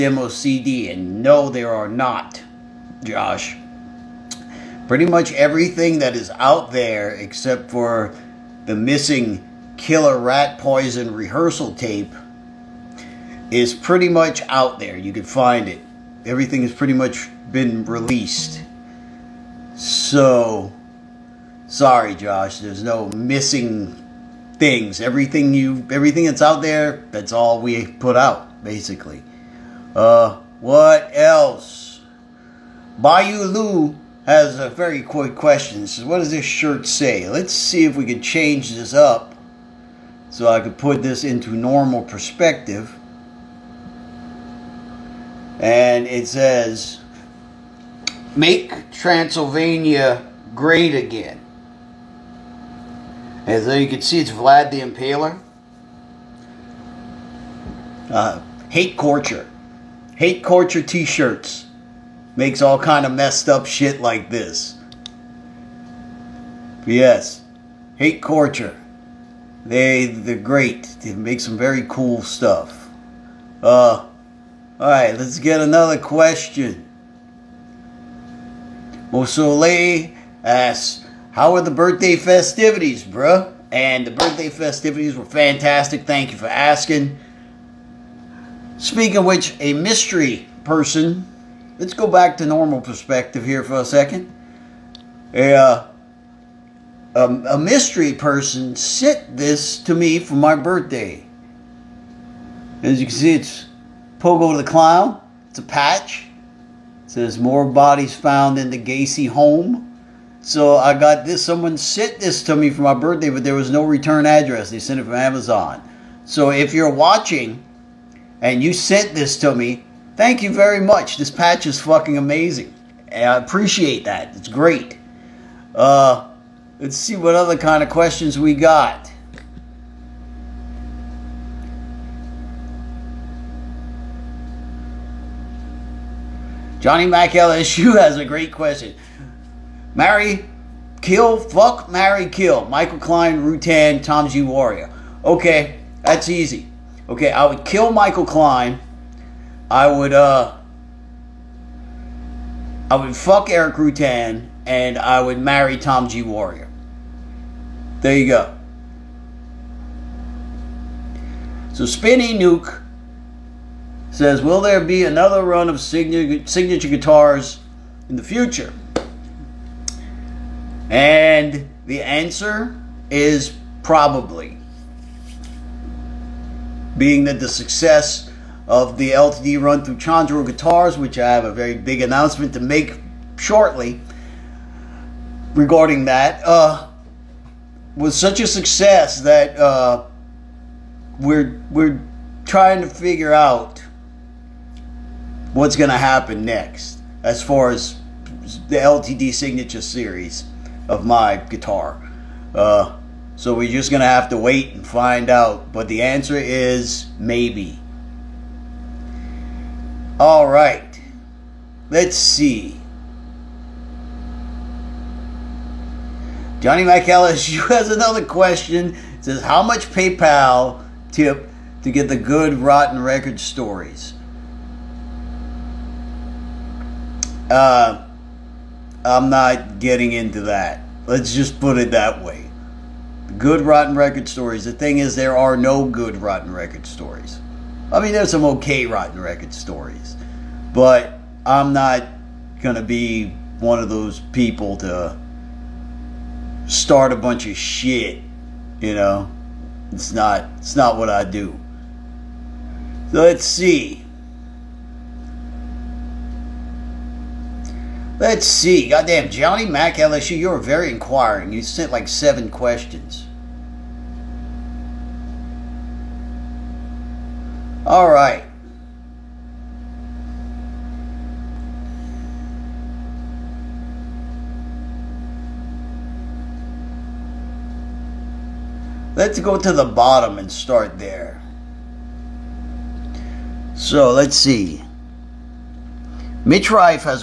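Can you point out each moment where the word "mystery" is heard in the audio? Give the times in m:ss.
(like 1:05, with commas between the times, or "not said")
1:29, 1:37.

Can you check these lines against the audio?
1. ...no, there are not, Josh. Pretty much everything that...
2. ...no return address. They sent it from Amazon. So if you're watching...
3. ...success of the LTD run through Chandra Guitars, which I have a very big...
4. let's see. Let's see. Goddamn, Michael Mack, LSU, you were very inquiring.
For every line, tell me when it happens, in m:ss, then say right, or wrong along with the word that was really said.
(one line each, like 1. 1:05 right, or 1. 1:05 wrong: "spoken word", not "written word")
1. 0:01 right
2. 1:53 right
3. 2:57 right
4. 4:13 wrong: "Johnny", not "Michael".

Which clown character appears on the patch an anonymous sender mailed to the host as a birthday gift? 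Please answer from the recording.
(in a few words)
Pogo the Clown.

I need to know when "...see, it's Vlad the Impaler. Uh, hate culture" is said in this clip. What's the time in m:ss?
0:54.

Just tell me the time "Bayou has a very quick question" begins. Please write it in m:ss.
0:32.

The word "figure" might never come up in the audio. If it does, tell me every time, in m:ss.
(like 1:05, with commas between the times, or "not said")
3:12.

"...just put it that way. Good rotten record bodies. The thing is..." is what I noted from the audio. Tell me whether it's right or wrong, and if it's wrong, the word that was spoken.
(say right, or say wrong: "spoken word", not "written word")
wrong: "stories", not "bodies".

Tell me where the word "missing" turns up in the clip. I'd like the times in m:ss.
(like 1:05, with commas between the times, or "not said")
0:08, 0:23.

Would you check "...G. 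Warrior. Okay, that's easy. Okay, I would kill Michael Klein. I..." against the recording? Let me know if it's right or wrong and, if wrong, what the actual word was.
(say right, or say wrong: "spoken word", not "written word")
right.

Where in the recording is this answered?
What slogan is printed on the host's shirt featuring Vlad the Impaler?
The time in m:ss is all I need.
0:48.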